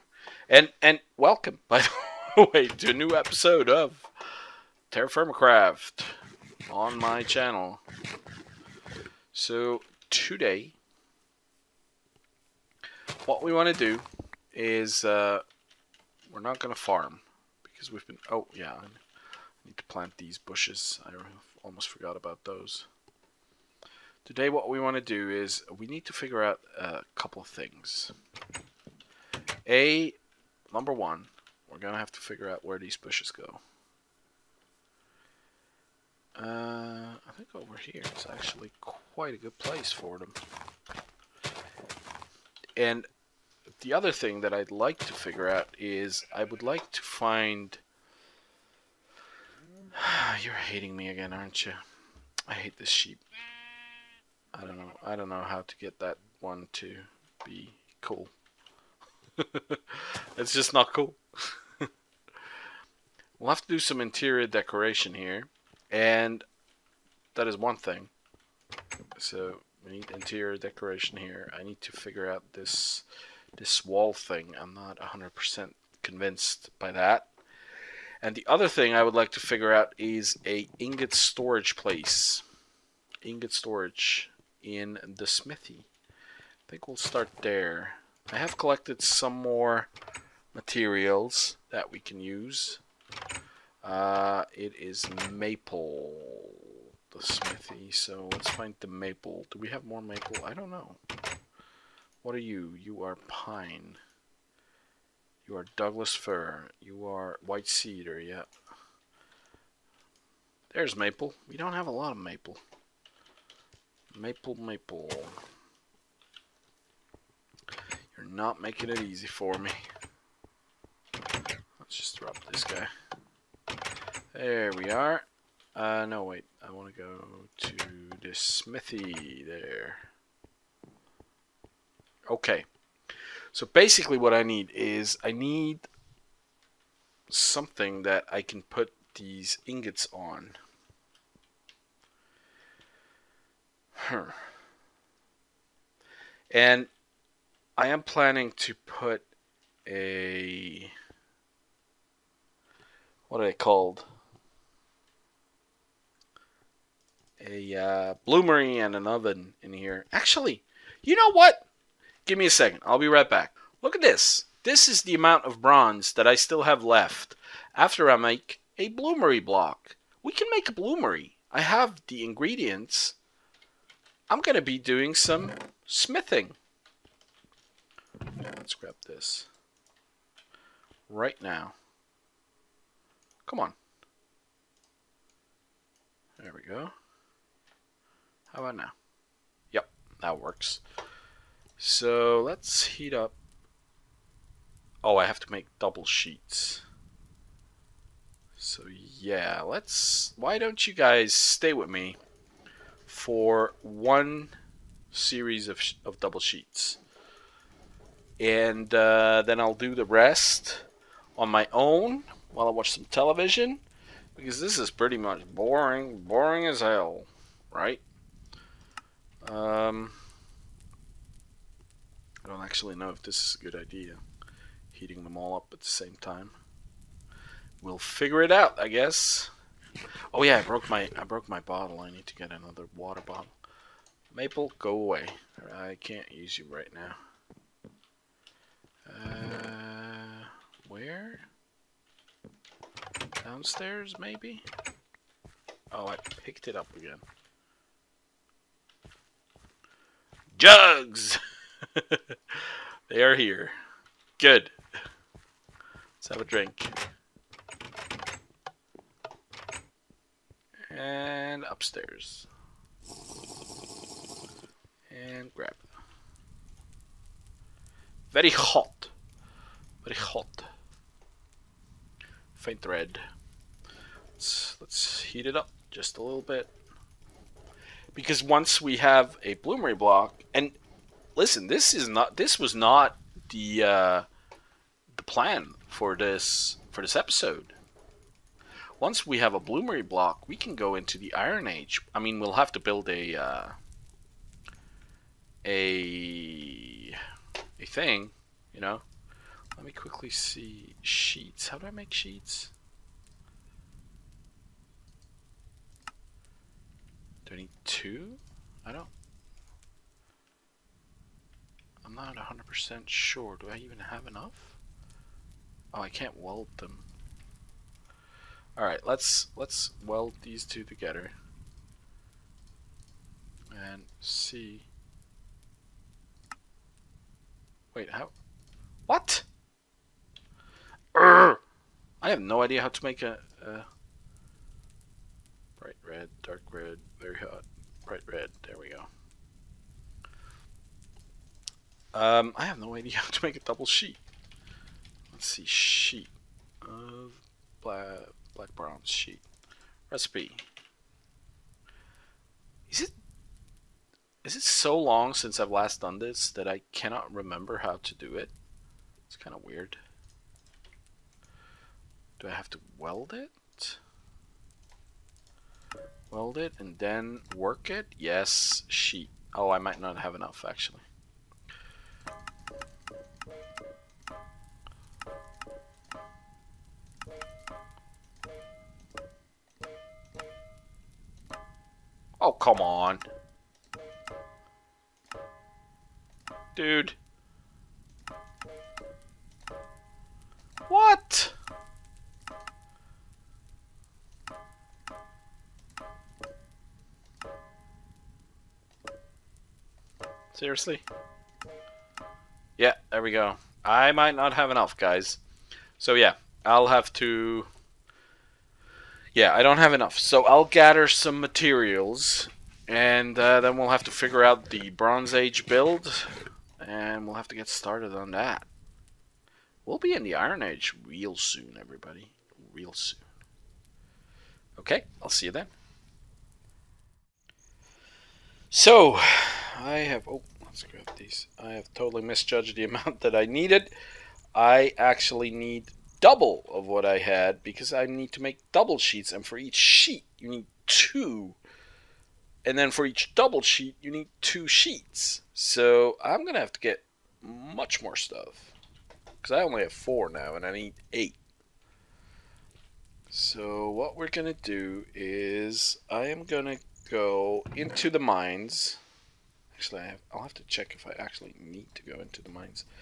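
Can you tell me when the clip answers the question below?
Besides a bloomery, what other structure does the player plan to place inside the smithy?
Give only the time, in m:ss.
2:38.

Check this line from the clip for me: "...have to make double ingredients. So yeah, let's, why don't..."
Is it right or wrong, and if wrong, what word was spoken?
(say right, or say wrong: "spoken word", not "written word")
wrong: "sheets", not "ingredients".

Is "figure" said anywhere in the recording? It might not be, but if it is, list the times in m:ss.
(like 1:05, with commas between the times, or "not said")
0:26, 0:32, 0:45, 1:11, 1:19, 3:47, 6:54.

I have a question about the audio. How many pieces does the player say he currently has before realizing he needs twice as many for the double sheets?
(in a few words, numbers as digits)
4.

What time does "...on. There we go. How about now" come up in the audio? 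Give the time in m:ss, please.
3:03.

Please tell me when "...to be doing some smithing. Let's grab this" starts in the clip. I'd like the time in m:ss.
2:54.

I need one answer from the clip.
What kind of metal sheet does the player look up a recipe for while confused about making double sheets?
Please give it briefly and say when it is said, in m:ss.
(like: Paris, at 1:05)
Black bronze, at 5:48.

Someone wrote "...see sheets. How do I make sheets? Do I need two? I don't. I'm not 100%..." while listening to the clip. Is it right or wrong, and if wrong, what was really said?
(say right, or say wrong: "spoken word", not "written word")
right.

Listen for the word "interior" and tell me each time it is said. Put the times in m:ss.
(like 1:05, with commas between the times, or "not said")
1:04, 1:10.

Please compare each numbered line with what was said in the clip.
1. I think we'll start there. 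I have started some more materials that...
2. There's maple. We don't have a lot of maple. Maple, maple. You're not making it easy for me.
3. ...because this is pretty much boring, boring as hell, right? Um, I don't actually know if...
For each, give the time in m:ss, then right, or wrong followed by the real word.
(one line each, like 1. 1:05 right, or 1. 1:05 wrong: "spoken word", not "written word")
1. 1:26 wrong: "collected", not "started"
2. 1:50 right
3. 3:34 right.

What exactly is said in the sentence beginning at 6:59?
We'll be in the Iron Age real soon, everybody.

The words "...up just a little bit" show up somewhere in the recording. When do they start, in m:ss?
4:35.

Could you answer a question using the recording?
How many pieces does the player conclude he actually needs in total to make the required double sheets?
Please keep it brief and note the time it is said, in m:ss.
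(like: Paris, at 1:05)
8, at 7:31.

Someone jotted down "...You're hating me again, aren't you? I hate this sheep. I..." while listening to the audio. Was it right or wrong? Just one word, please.
right.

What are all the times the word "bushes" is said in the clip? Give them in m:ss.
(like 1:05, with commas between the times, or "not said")
0:20, 0:32.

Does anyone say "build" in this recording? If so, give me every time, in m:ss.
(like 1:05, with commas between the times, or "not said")
4:52, 6:55.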